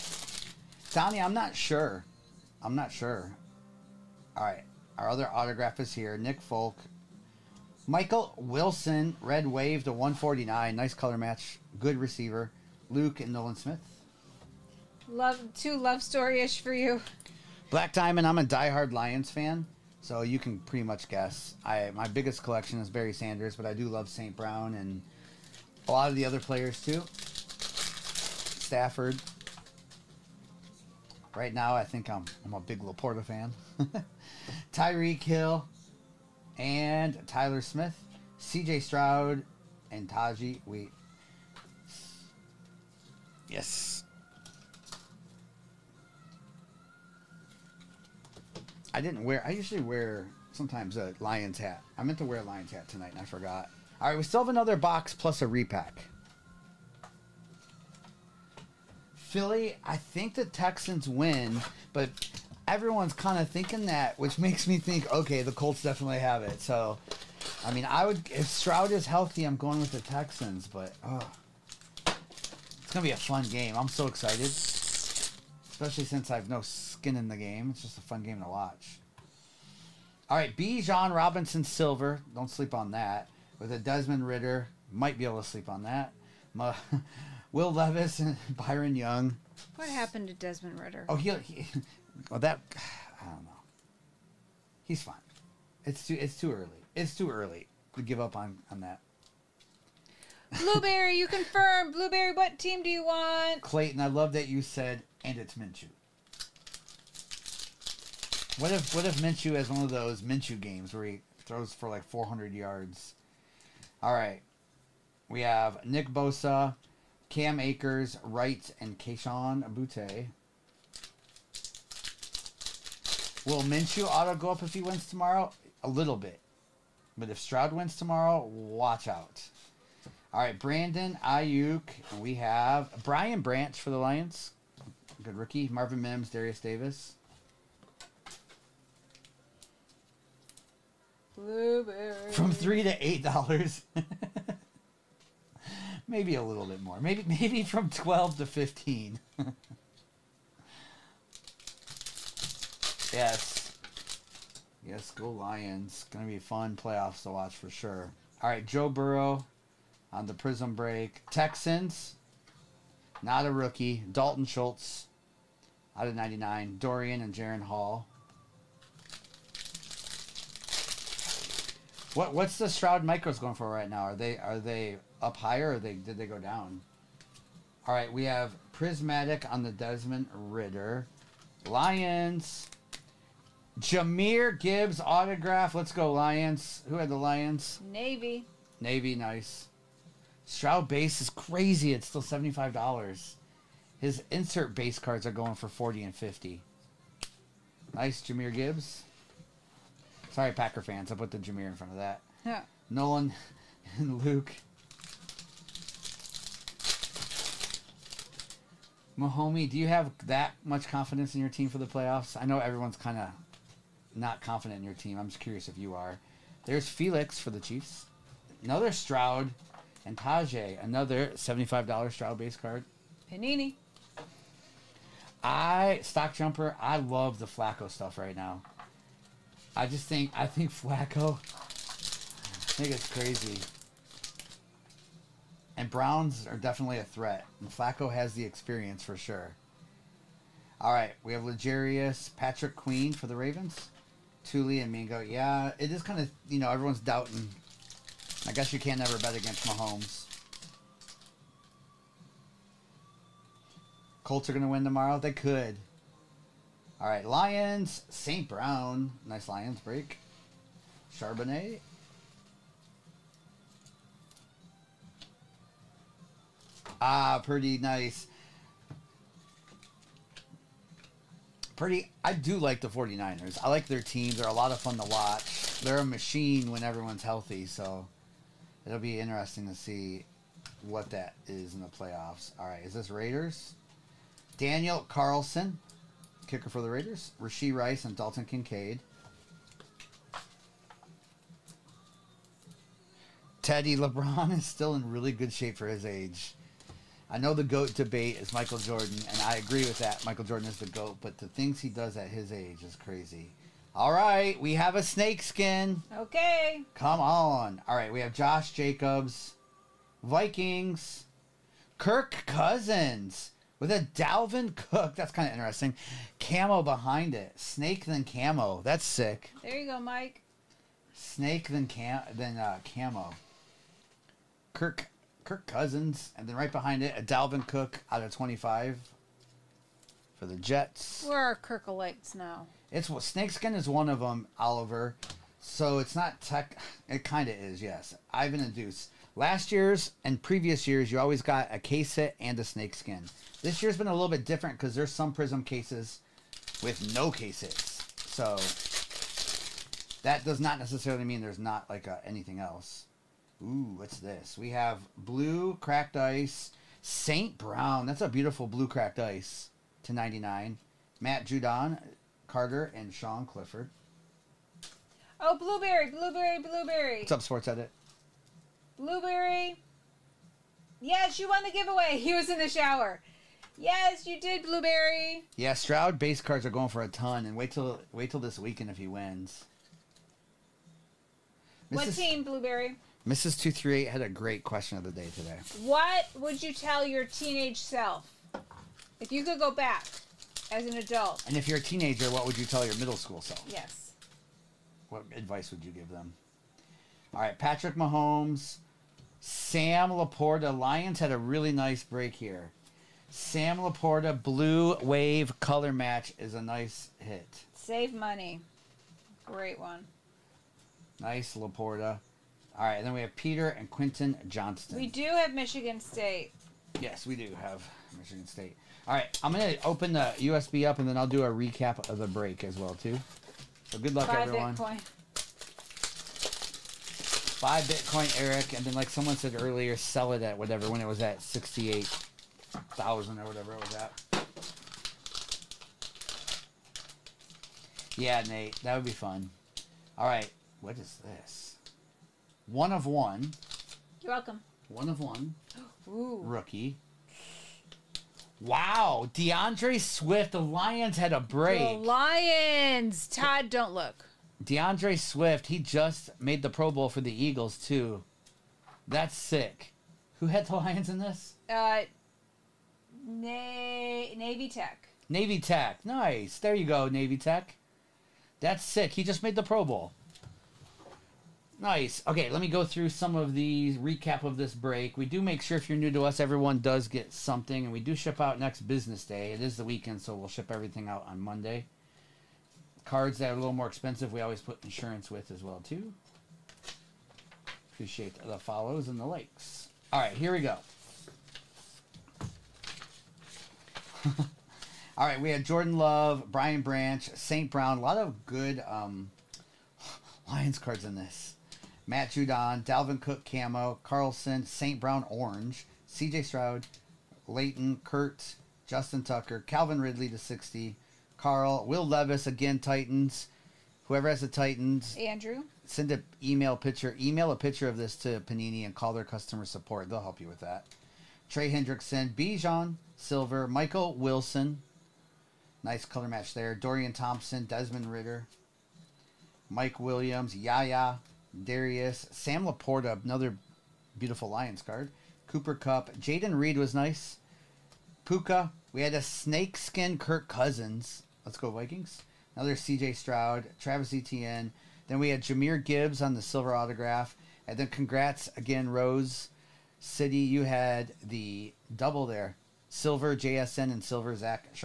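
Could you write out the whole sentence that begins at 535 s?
Cooper Kupp, Jayden Reed was nice.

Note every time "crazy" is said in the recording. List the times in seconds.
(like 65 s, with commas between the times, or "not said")
191 s, 233 s, 302 s.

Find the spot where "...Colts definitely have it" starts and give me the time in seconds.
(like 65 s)
65 s.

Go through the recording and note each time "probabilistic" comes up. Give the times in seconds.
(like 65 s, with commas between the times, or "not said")
not said.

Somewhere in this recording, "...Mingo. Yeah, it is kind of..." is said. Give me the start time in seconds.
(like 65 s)
244 s.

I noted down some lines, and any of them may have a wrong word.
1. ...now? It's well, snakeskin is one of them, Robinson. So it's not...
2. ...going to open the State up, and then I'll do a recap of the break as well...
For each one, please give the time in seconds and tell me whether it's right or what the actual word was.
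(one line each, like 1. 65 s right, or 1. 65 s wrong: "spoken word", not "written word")
1. 332 s wrong: "Oliver", not "Robinson"
2. 419 s wrong: "USB", not "State".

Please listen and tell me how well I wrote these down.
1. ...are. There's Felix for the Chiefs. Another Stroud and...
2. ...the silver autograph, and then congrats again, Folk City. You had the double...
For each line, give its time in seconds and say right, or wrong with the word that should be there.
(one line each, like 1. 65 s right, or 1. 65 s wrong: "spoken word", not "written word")
1. 215 s right
2. 546 s wrong: "Rose", not "Folk".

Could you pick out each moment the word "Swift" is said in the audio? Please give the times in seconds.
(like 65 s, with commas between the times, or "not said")
449 s, 455 s.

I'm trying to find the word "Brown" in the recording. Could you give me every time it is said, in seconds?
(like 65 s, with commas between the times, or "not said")
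24 s, 235 s, 258 s, 357 s, 497 s, 504 s.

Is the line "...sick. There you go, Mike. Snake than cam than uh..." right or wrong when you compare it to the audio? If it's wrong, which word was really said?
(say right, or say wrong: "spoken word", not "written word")
right.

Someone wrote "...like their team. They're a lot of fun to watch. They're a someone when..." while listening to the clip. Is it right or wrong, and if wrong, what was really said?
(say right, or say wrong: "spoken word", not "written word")
wrong: "machine", not "someone".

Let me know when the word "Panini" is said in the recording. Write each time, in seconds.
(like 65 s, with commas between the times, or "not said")
223 s, 518 s.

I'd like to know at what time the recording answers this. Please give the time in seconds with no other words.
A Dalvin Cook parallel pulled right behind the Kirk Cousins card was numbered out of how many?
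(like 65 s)
328 s.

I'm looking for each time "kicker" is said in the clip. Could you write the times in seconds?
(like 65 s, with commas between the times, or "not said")
286 s.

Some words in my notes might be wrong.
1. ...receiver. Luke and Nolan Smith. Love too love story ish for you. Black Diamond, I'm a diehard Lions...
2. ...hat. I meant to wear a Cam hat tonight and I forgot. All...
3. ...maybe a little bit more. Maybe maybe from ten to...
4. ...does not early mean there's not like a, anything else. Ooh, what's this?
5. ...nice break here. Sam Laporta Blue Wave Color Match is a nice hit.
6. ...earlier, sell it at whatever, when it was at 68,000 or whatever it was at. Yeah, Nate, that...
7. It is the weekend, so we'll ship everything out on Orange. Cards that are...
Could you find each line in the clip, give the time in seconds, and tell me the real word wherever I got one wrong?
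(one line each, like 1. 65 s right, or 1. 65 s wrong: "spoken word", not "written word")
1. 11 s right
2. 51 s wrong: "Lions", not "Cam"
3. 146 s wrong: "twelve", not "ten"
4. 350 s wrong: "necessarily", not "early"
5. 401 s right
6. 429 s right
7. 479 s wrong: "Monday", not "Orange".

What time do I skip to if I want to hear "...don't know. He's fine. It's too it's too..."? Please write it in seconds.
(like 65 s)
93 s.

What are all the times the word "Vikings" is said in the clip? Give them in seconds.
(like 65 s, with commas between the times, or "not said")
310 s, 541 s.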